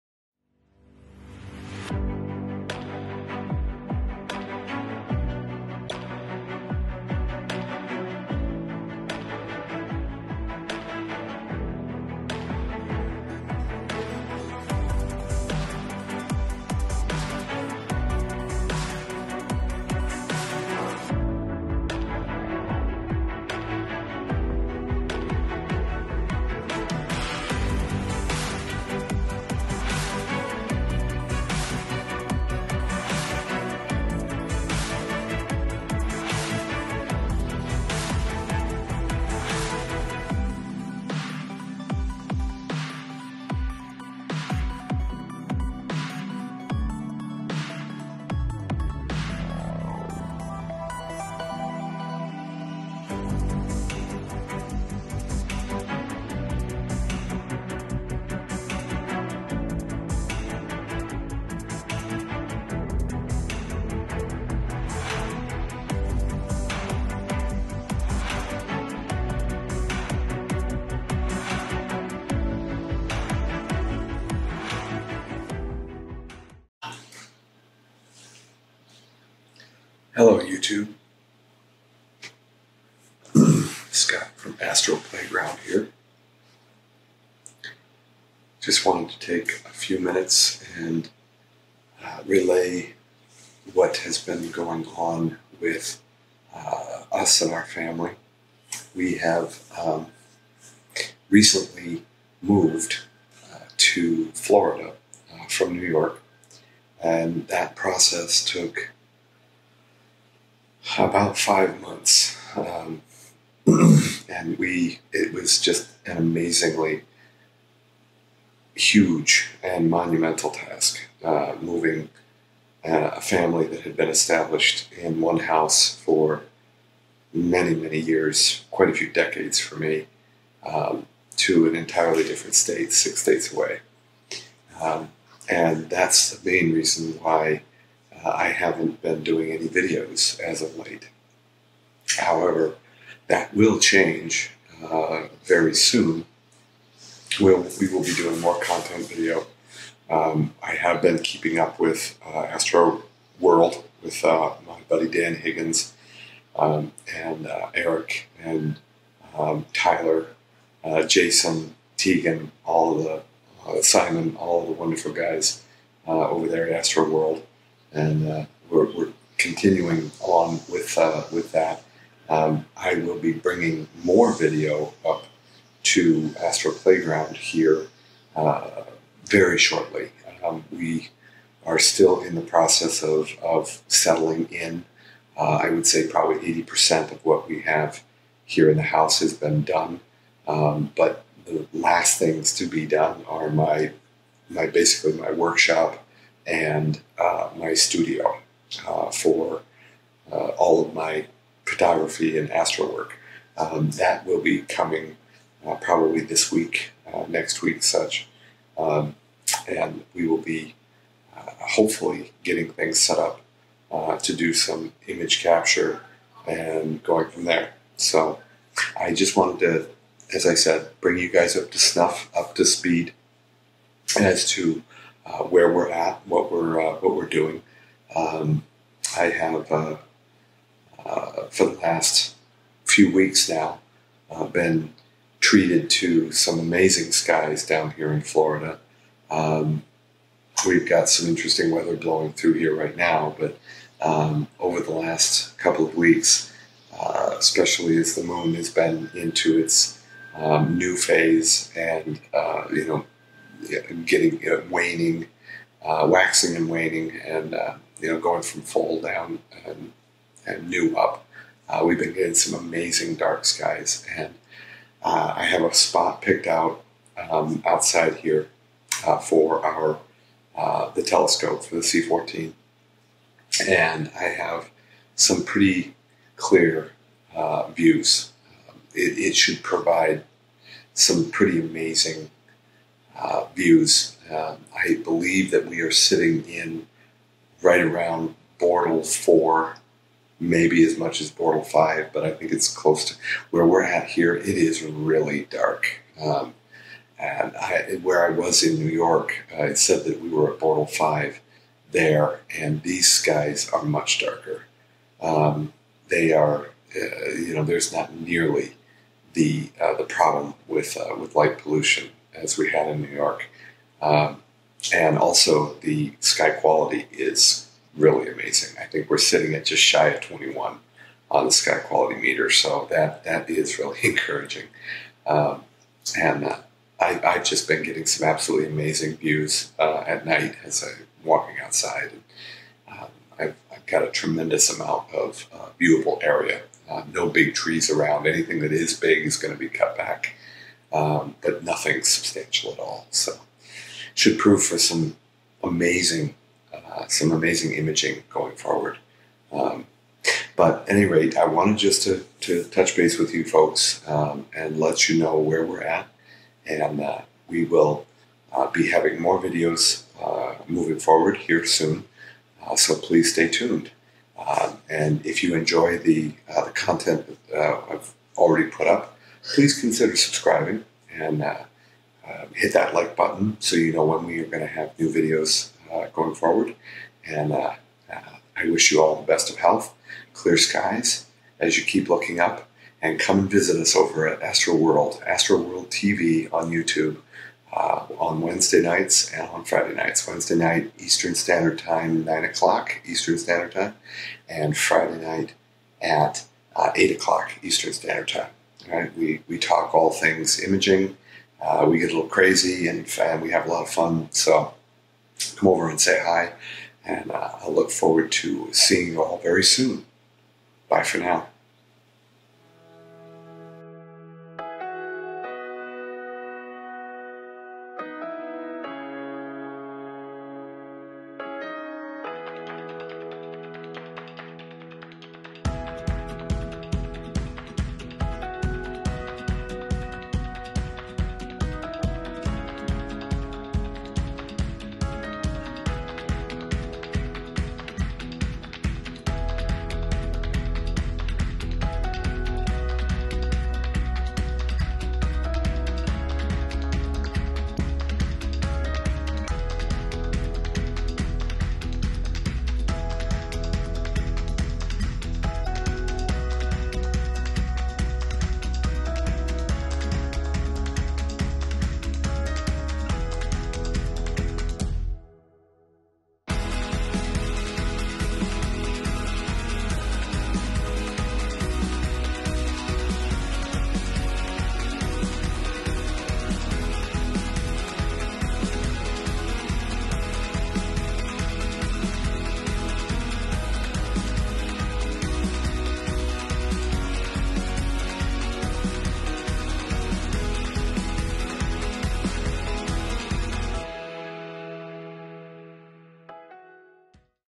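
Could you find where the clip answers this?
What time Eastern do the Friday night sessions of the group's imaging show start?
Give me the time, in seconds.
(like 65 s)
396 s.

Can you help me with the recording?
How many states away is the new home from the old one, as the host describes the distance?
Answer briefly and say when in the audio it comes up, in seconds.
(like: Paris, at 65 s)
six, at 132 s.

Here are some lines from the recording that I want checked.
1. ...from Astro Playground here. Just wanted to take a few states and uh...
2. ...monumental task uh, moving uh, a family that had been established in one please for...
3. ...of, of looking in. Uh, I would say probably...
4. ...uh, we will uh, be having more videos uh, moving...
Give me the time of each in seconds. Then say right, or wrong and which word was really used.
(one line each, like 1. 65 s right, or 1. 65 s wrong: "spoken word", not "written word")
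1. 84 s wrong: "minutes", not "states"
2. 119 s wrong: "house", not "please"
3. 183 s wrong: "settling", not "looking"
4. 357 s right.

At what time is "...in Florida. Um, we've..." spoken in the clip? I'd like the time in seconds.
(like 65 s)
238 s.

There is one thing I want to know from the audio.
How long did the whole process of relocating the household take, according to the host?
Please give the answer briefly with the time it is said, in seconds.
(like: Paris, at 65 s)
five months, at 111 s.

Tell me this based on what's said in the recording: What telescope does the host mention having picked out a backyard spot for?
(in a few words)
C14.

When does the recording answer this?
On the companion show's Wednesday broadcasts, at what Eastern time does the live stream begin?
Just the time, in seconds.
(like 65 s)
392 s.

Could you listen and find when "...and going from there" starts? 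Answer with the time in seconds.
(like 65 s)
216 s.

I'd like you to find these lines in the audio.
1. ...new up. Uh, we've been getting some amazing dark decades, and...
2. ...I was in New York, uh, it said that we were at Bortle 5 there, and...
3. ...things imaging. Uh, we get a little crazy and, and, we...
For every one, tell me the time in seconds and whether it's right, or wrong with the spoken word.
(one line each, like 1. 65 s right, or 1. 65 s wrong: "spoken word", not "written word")
1. 260 s wrong: "skies", not "decades"
2. 298 s right
3. 400 s right.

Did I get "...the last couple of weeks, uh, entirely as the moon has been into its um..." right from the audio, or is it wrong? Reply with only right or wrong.
wrong.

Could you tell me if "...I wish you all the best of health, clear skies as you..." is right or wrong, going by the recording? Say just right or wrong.
right.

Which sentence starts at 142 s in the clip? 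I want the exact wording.
However, that will change uh, very soon.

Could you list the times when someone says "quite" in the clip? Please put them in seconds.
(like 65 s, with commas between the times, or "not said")
128 s.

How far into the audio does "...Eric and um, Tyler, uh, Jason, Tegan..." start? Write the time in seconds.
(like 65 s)
157 s.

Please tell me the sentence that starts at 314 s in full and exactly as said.
Um, and also, the sky quality is really amazing.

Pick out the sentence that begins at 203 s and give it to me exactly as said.
Um, that will be coming uh, probably this week, next week, such.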